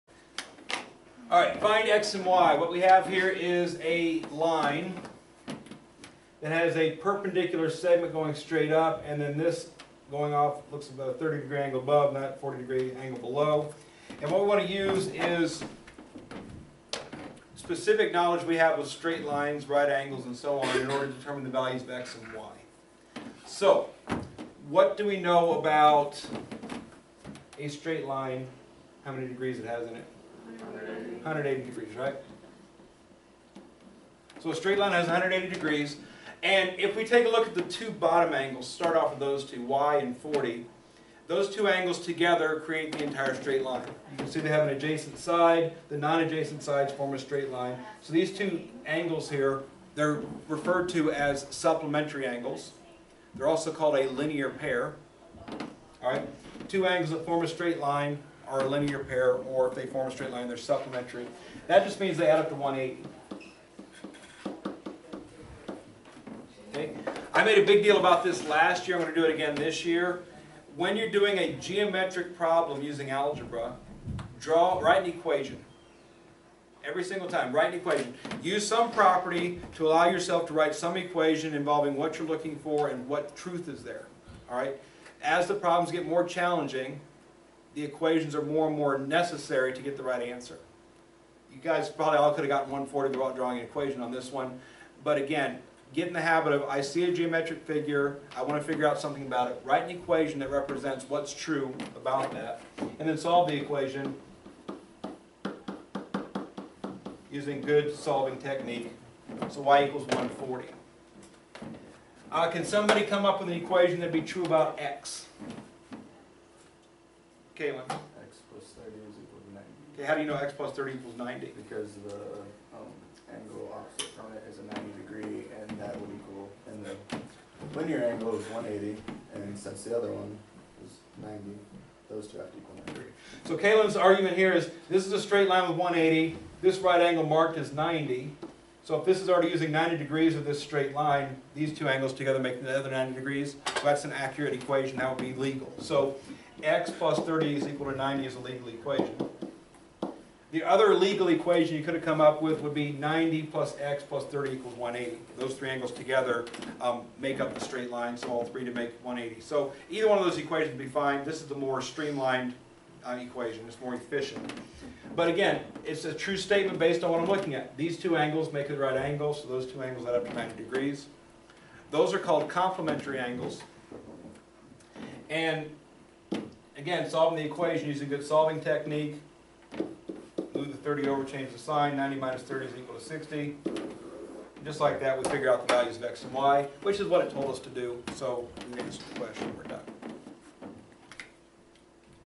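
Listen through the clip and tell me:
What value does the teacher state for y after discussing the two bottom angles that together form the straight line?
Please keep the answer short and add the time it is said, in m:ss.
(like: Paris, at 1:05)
140, at 1:49.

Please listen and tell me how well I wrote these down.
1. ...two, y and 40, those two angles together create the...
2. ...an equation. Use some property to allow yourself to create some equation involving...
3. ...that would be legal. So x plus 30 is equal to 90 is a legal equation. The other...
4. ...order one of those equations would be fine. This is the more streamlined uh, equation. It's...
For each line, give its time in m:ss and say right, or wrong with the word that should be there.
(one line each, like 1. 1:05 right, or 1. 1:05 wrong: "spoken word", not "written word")
1. 0:39 right
2. 1:17 wrong: "write", not "create"
3. 2:24 right
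4. 2:39 wrong: "either", not "order".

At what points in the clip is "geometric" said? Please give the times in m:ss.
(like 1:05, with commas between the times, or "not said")
1:11, 1:37.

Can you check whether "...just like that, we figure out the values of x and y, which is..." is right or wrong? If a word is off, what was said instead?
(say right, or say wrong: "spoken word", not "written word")
right.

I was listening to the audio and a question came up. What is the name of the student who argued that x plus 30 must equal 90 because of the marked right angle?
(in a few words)
Kalen.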